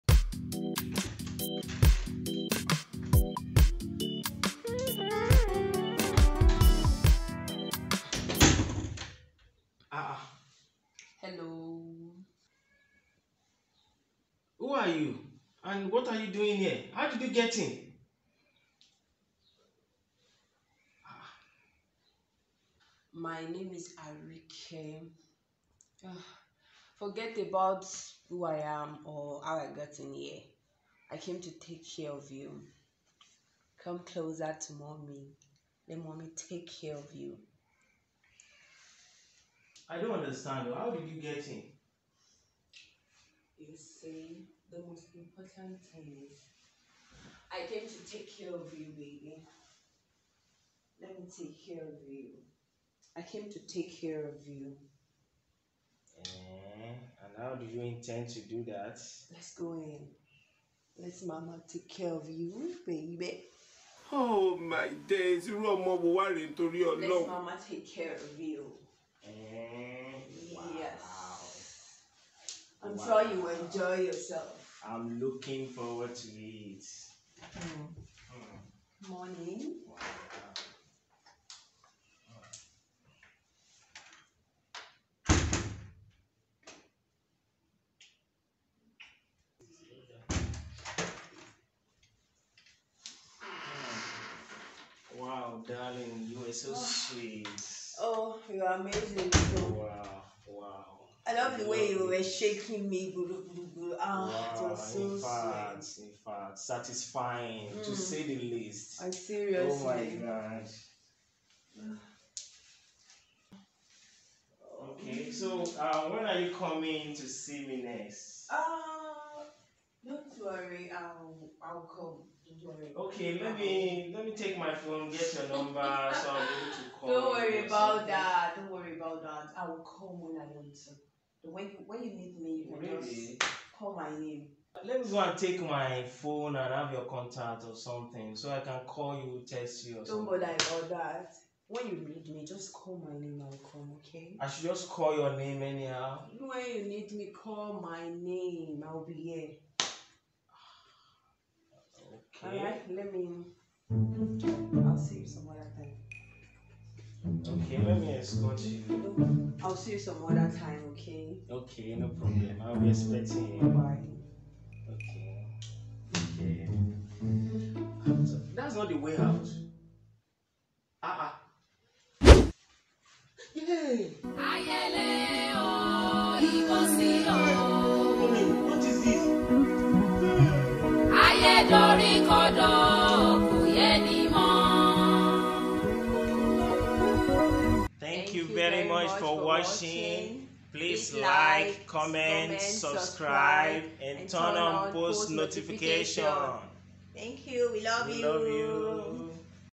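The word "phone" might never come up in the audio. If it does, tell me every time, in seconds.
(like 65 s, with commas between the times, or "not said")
124 s, 136 s.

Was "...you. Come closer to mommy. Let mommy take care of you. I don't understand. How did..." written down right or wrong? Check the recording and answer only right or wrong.
right.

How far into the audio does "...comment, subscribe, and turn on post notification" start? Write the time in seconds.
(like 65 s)
191 s.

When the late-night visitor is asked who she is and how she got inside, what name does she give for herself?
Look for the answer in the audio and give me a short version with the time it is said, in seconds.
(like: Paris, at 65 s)
Arike, at 24 s.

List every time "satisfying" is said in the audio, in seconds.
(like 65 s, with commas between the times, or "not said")
106 s.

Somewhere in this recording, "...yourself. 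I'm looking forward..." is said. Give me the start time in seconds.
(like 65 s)
74 s.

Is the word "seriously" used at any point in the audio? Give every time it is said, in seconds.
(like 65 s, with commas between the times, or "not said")
109 s.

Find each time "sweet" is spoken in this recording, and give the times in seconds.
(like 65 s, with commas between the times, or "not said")
96 s, 105 s.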